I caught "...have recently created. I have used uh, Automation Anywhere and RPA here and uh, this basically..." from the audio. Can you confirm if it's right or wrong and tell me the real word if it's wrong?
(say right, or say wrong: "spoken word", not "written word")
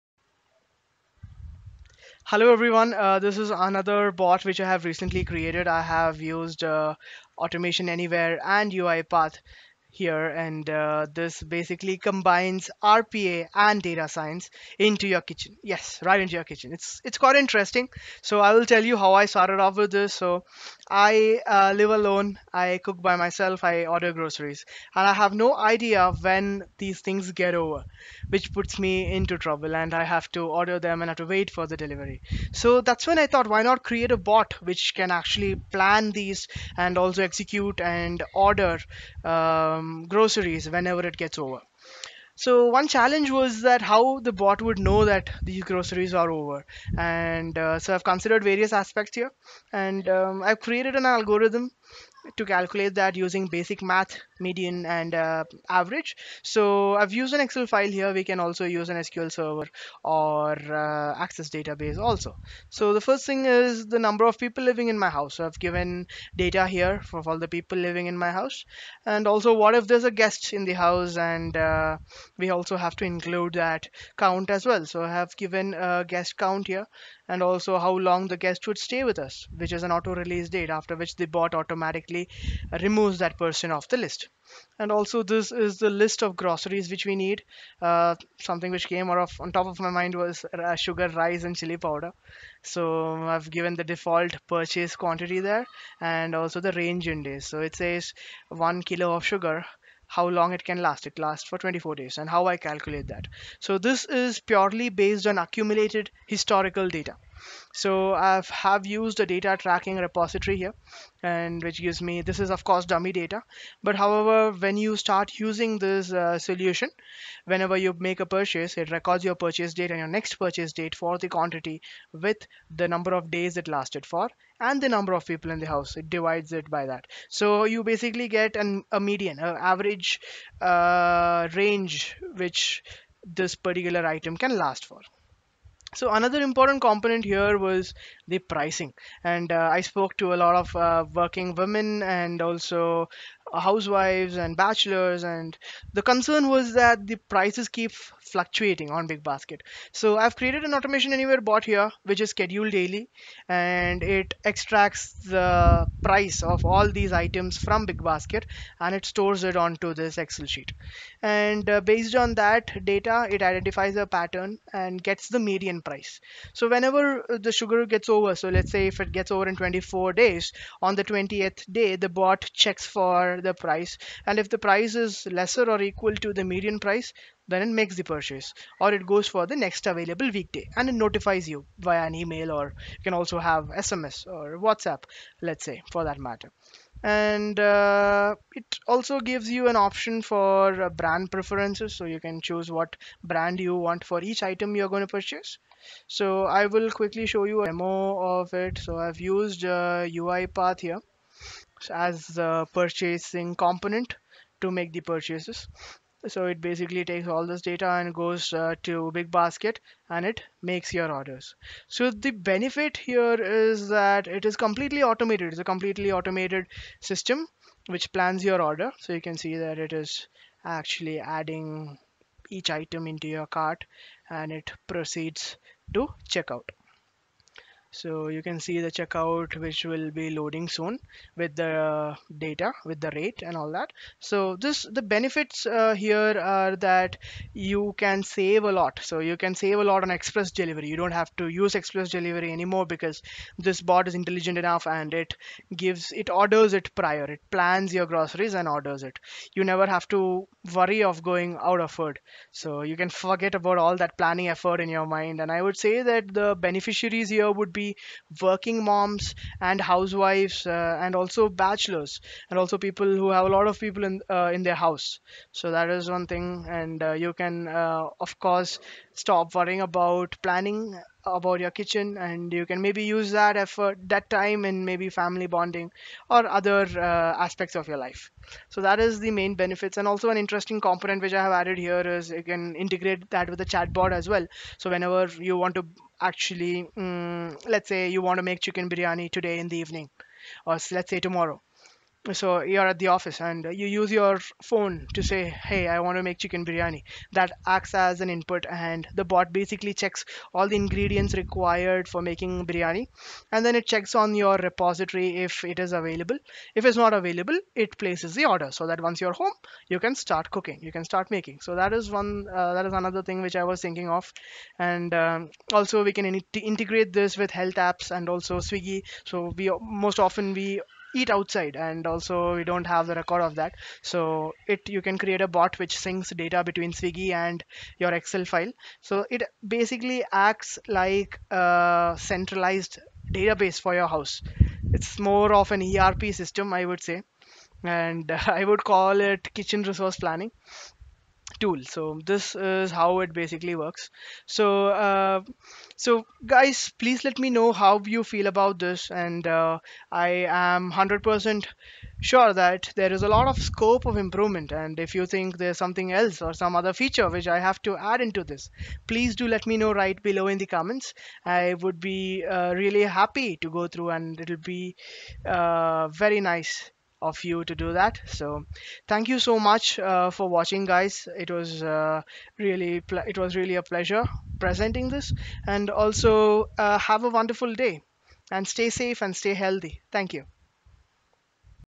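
wrong: "UiPath", not "RPA".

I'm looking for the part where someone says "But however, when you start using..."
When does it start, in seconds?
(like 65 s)
113 s.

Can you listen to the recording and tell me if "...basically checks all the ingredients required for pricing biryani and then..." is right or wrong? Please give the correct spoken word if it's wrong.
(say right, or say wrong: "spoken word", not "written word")
wrong: "making", not "pricing".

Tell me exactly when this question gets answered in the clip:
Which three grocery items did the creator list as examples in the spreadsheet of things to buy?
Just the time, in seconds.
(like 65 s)
90 s.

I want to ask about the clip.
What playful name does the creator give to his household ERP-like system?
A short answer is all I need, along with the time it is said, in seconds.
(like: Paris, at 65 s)
kitchen resource planning tool, at 339 s.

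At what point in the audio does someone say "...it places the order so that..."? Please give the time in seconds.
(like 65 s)
307 s.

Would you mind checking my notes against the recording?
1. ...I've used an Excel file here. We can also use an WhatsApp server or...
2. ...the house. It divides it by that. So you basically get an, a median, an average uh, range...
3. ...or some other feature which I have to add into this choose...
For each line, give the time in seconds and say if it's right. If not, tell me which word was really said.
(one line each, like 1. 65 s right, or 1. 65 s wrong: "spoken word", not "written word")
1. 56 s wrong: "SQL", not "WhatsApp"
2. 125 s right
3. 356 s wrong: "please", not "choose".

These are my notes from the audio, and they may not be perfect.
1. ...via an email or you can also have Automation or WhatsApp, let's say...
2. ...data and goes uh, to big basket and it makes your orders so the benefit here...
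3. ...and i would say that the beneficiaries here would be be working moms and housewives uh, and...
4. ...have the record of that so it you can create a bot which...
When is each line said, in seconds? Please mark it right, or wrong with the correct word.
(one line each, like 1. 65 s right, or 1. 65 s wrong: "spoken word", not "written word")
1. 181 s wrong: "SMS", not "Automation"
2. 207 s right
3. 255 s right
4. 322 s right.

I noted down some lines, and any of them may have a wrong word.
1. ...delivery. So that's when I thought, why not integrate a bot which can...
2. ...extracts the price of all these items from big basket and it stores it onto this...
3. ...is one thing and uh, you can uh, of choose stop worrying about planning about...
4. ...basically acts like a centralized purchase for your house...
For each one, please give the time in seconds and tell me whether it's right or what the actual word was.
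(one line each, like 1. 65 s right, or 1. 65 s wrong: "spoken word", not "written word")
1. 31 s wrong: "create", not "integrate"
2. 154 s right
3. 265 s wrong: "course", not "choose"
4. 329 s wrong: "database", not "purchase".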